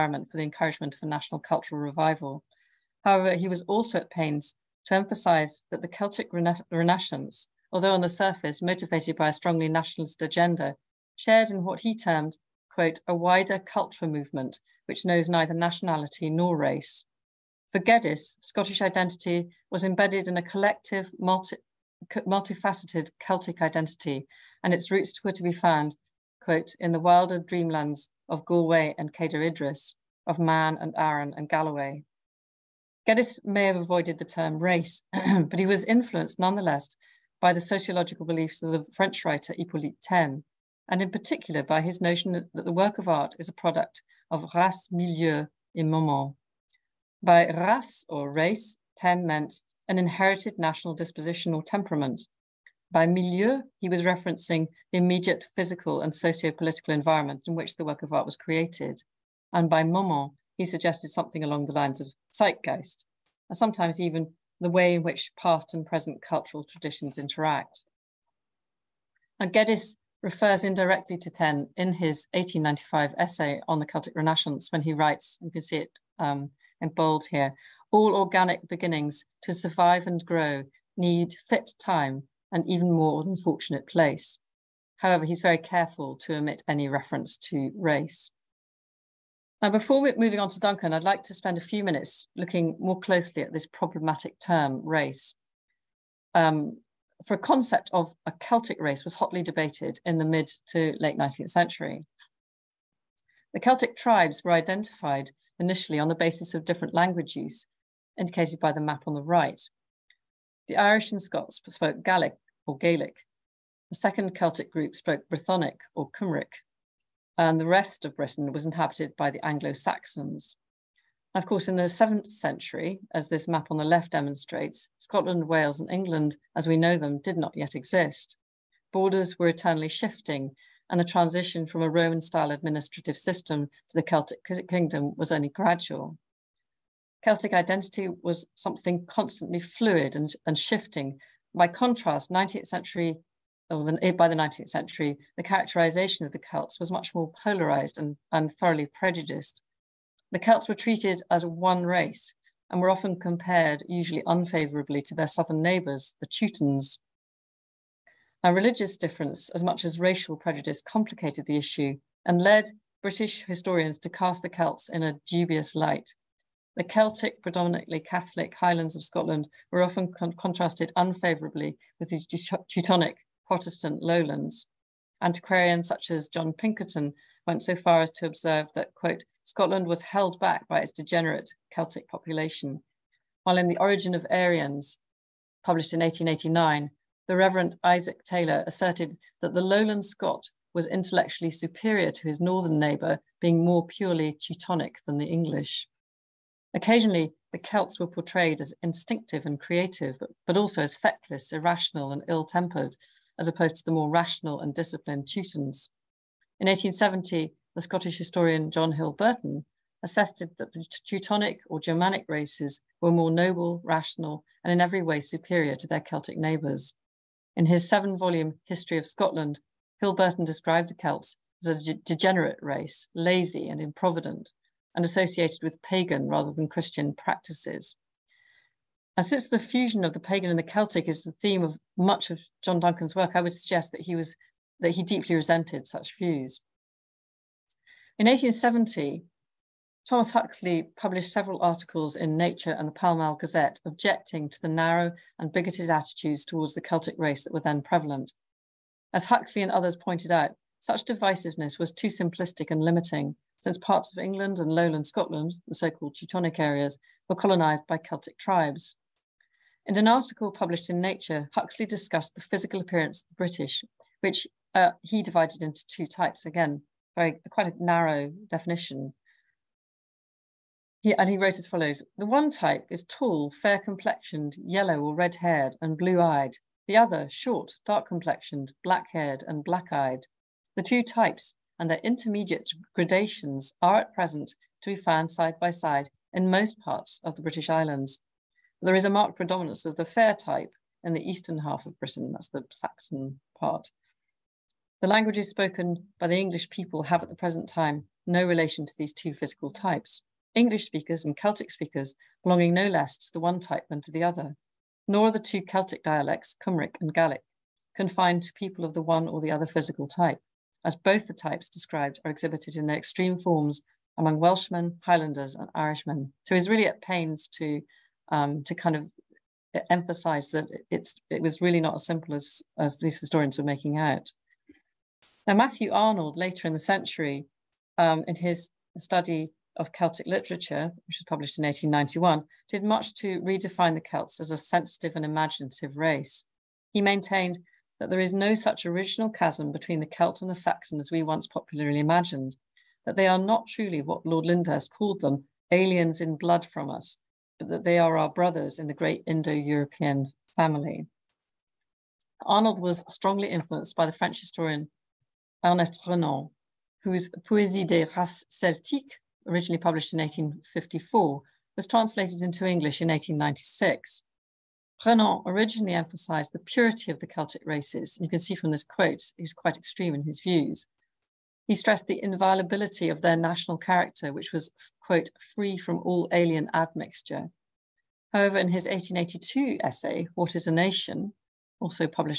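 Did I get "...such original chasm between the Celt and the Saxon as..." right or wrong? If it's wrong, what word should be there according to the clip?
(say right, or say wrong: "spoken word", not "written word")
right.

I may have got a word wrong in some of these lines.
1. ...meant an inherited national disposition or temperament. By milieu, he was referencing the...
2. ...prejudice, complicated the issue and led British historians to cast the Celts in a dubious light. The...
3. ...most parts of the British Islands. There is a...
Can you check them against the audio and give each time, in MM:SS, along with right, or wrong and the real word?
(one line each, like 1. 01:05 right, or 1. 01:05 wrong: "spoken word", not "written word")
1. 00:49 right
2. 02:40 right
3. 04:46 right.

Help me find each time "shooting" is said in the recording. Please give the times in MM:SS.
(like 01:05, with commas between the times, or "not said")
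not said.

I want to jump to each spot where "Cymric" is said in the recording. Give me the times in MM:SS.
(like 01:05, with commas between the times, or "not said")
01:56, 05:06.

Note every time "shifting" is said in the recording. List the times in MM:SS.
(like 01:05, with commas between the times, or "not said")
02:09, 02:20.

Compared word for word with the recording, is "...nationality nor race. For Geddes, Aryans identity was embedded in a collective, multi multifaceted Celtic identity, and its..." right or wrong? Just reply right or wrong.
wrong.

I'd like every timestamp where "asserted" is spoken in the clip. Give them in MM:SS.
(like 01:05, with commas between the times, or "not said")
03:08, 03:30.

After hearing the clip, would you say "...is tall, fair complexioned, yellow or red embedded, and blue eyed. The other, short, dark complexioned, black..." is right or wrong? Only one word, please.
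wrong.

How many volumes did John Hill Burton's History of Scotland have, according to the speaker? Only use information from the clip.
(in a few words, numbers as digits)
7.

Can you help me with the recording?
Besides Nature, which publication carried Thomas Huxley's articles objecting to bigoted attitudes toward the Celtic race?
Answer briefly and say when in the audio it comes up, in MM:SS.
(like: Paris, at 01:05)
Pall Mall Gazette, at 04:02.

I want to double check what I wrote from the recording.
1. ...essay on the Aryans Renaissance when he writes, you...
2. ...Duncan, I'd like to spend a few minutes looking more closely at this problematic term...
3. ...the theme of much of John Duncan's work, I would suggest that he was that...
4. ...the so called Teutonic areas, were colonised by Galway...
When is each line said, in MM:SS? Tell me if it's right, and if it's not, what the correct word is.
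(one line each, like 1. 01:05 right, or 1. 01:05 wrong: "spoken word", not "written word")
1. 01:13 wrong: "Celtic", not "Aryans"
2. 01:30 right
3. 03:51 right
4. 04:15 wrong: "Celtic", not "Galway".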